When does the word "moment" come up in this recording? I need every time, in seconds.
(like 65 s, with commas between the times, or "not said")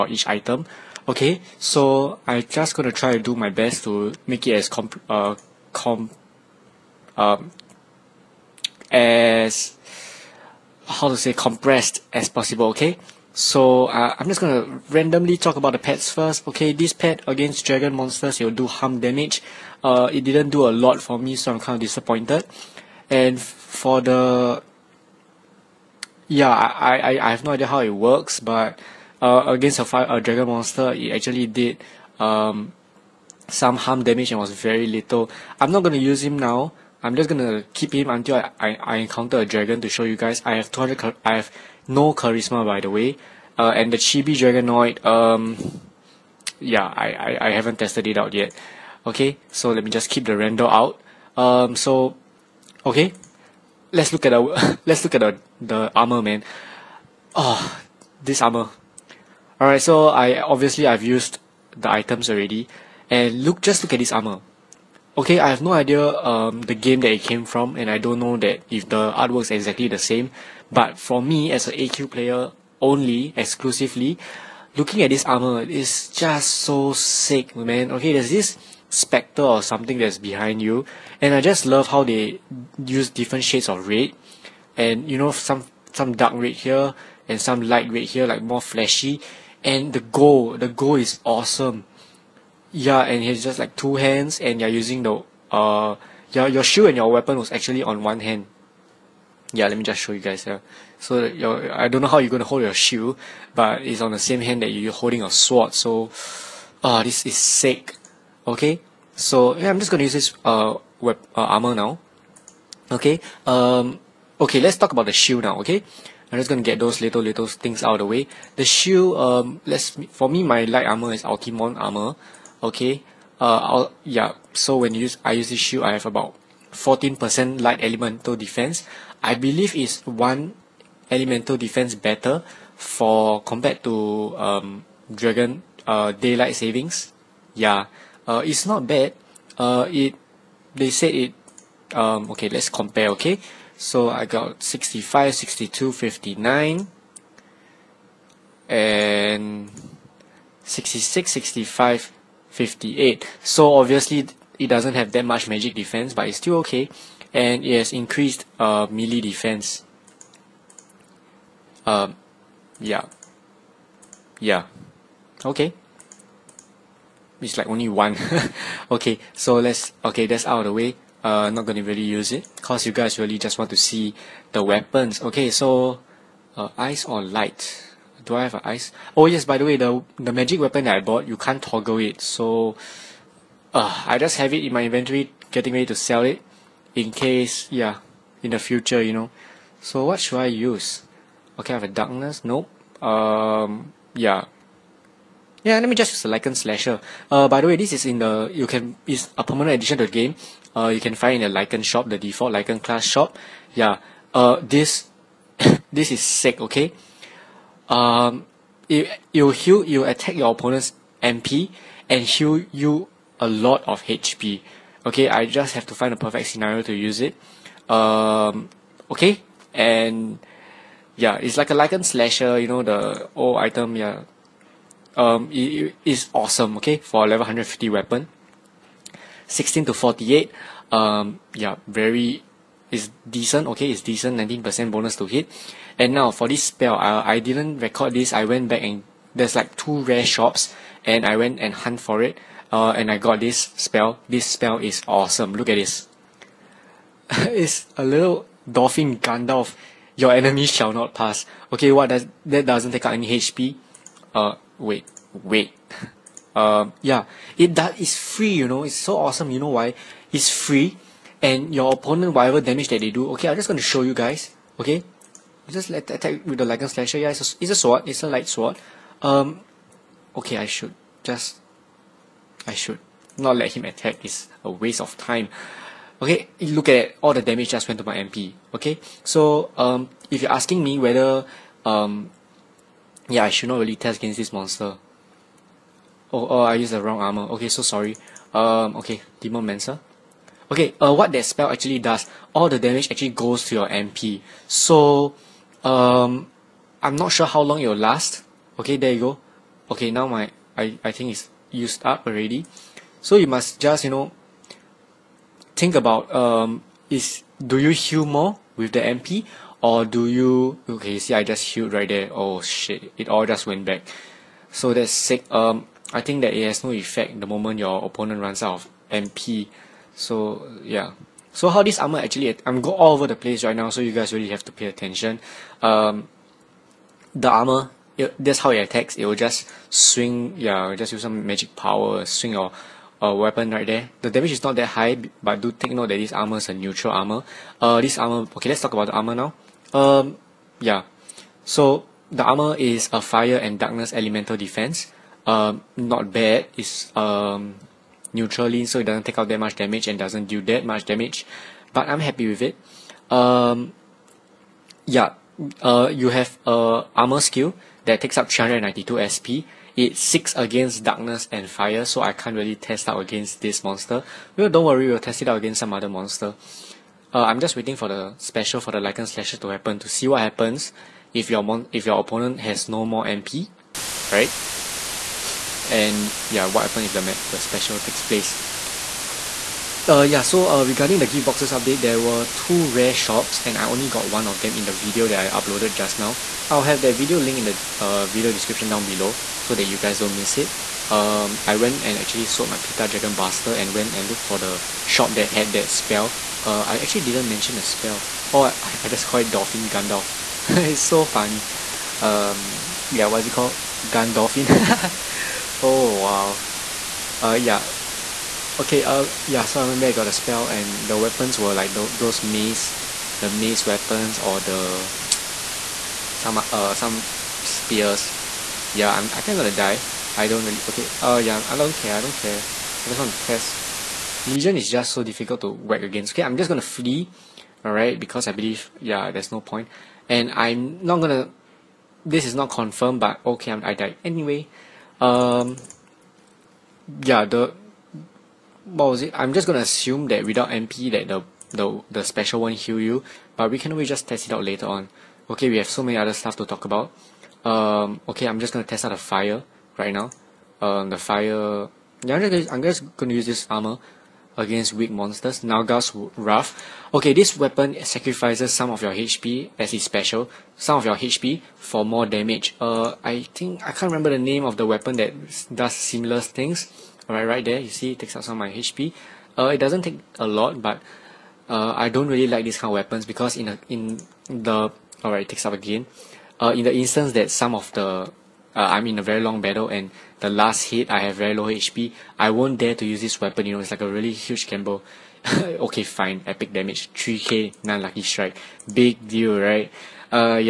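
317 s.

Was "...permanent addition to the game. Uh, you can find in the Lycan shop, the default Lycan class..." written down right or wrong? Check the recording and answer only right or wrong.
right.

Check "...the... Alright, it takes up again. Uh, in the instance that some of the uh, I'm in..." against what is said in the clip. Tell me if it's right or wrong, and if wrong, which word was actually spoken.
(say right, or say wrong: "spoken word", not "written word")
right.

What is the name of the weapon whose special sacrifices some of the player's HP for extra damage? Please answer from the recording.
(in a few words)
Nulgath's Wrath.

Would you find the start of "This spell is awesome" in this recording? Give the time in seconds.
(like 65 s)
244 s.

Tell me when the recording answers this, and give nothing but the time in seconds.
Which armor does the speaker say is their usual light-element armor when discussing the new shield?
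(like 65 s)
121 s.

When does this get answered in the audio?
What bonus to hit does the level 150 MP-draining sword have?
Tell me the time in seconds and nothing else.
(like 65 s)
234 s.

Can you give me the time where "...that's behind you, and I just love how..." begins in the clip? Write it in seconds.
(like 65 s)
79 s.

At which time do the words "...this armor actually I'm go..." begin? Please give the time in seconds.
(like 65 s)
321 s.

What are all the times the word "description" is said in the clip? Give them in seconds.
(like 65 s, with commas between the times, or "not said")
388 s.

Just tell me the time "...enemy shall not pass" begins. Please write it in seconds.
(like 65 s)
250 s.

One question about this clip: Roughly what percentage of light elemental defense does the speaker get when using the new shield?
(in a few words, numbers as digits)
14%.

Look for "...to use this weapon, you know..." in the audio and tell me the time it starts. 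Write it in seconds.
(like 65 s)
482 s.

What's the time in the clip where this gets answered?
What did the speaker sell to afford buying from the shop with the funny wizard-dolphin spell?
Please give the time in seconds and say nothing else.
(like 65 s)
392 s.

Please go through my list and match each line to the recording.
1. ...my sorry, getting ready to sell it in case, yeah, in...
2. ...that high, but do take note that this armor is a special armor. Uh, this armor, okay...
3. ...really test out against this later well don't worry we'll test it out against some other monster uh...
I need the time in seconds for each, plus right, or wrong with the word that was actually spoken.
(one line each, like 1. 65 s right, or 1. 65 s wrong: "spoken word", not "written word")
1. 184 s wrong: "inventory", not "sorry"
2. 334 s wrong: "neutral", not "special"
3. 362 s wrong: "monster", not "later".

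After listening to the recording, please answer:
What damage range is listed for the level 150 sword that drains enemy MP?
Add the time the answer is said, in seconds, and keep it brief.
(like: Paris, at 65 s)
16 to 48, at 229 s.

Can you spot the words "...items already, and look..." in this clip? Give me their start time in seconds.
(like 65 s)
61 s.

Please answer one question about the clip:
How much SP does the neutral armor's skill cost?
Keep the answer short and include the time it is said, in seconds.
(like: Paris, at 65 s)
392, at 358 s.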